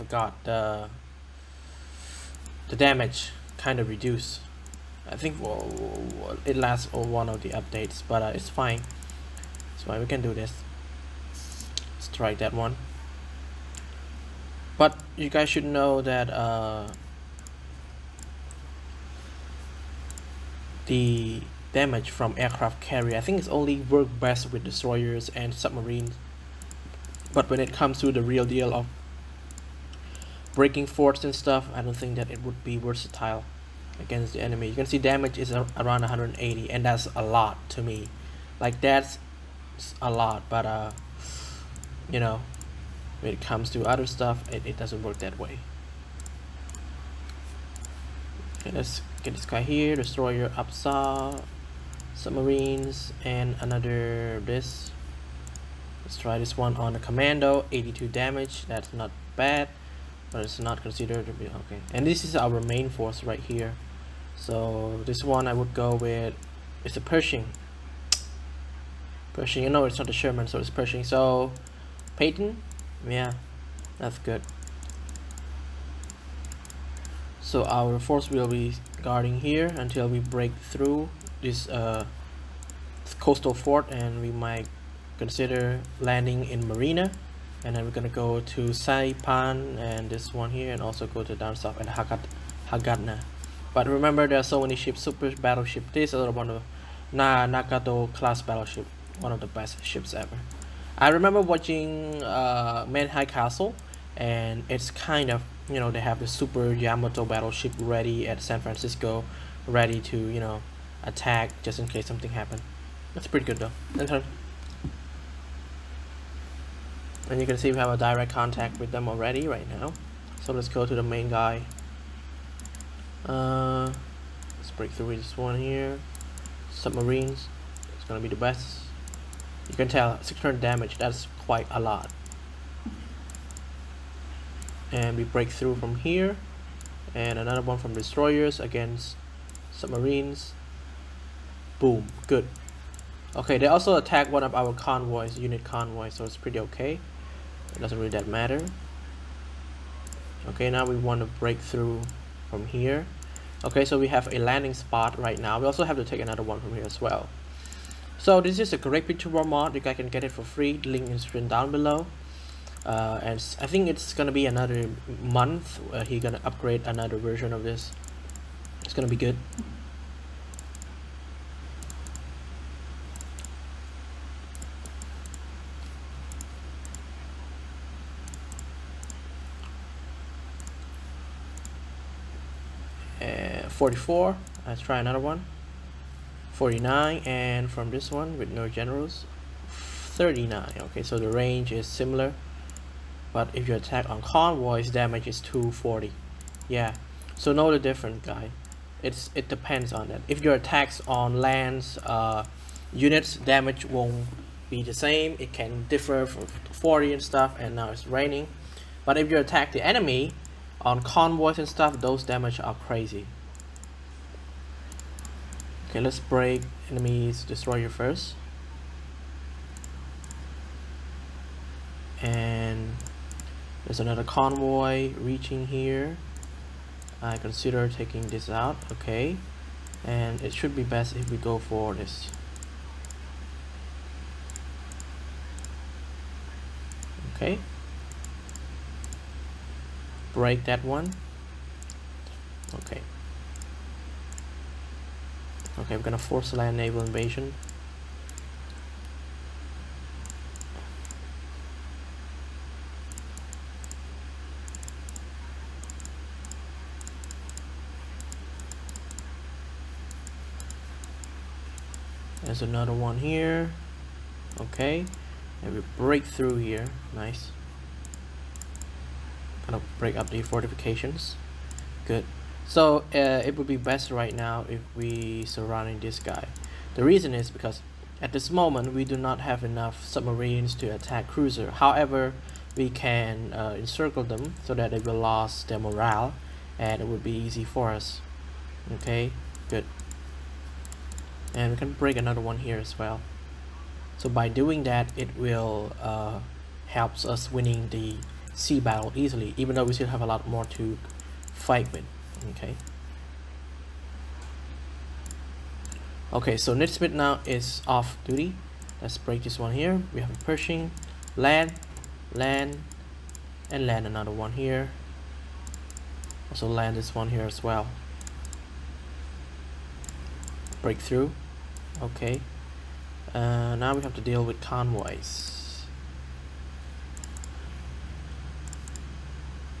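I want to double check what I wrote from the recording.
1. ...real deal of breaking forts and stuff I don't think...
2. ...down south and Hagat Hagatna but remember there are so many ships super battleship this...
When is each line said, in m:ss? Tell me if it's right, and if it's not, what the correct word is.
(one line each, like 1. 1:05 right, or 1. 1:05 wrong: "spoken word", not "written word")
1. 0:28 right
2. 1:31 right.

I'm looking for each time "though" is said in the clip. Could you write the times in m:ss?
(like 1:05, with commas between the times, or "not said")
1:53, 4:59.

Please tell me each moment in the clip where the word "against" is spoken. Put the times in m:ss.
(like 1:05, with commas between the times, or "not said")
0:33, 2:18.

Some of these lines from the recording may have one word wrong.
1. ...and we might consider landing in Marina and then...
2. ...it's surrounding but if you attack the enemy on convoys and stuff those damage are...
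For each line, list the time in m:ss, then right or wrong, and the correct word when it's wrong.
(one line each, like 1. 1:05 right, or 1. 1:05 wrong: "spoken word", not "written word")
1. 1:23 right
2. 3:27 wrong: "raining", not "surrounding".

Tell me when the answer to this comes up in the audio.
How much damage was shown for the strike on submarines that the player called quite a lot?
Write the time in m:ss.
2:10.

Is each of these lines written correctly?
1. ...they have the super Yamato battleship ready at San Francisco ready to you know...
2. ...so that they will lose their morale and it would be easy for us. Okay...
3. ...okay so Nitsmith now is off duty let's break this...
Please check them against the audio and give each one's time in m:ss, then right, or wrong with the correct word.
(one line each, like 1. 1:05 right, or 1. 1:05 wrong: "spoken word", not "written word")
1. 1:45 right
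2. 4:44 right
3. 5:06 right.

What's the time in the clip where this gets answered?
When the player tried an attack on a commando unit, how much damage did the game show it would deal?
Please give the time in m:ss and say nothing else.
0:57.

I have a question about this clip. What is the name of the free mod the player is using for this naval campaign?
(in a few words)
Great Patriotic War.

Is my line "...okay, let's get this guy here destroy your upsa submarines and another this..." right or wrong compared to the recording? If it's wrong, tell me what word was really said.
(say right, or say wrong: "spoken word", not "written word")
right.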